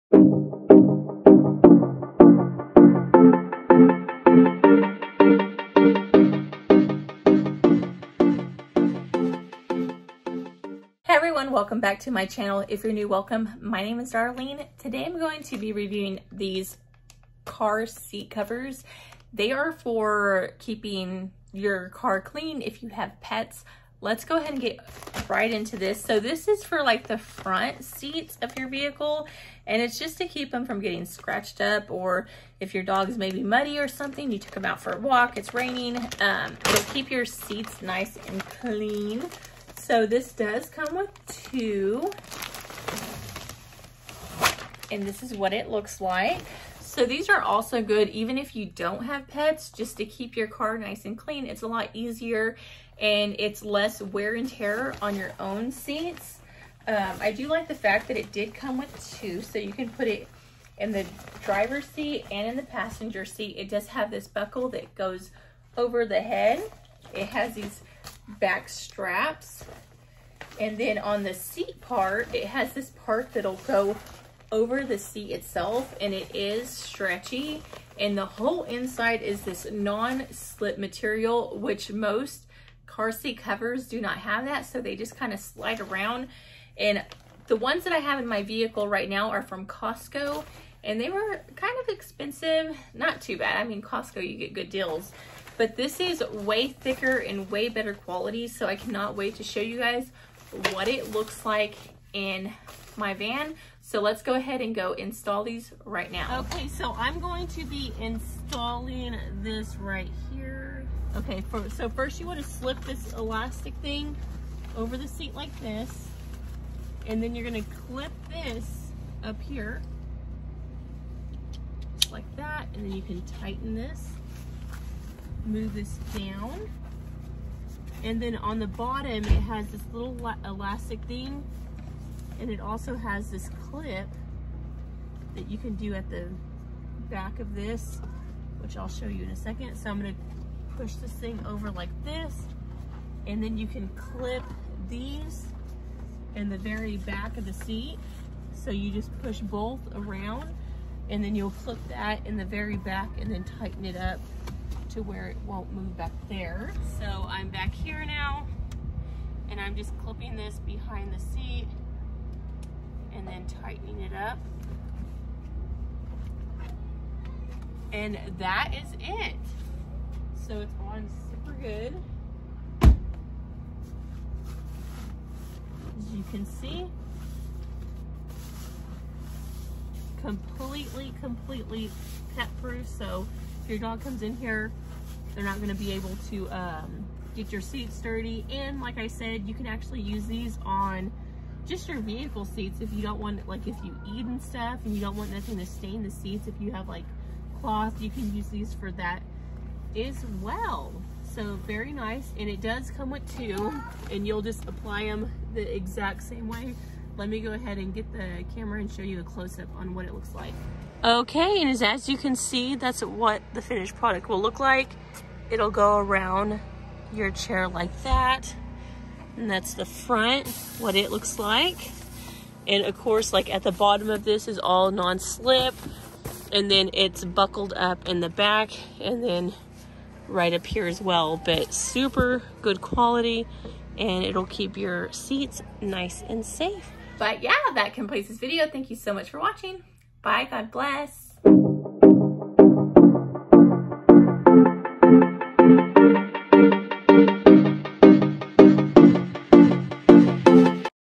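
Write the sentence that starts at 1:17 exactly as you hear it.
And the whole inside is this non-slip material, which most car seat covers do not have that.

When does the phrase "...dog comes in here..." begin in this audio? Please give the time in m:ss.
3:03.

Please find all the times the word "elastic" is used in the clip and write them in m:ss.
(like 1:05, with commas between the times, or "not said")
1:53, 2:10.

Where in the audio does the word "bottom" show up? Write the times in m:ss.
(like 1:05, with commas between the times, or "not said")
2:08, 3:43.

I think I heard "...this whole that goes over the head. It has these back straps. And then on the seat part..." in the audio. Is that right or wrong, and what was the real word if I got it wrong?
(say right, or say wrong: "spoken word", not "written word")
wrong: "buckle", not "whole".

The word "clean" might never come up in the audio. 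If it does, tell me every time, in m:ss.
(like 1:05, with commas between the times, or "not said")
0:22, 0:38, 0:51.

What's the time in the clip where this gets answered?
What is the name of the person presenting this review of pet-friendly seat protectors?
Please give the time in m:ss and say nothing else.
0:14.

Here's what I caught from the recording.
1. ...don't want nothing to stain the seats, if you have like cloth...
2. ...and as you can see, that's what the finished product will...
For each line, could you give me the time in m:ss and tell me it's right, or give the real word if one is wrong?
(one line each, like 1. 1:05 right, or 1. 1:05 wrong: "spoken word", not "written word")
1. 3:15 right
2. 3:31 right.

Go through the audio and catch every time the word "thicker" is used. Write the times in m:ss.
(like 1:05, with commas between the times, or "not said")
1:36.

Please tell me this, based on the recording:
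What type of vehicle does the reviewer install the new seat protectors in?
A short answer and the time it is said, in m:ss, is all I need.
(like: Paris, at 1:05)
Van, at 1:43.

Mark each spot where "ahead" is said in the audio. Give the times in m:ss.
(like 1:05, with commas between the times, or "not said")
0:24, 1:44, 3:27.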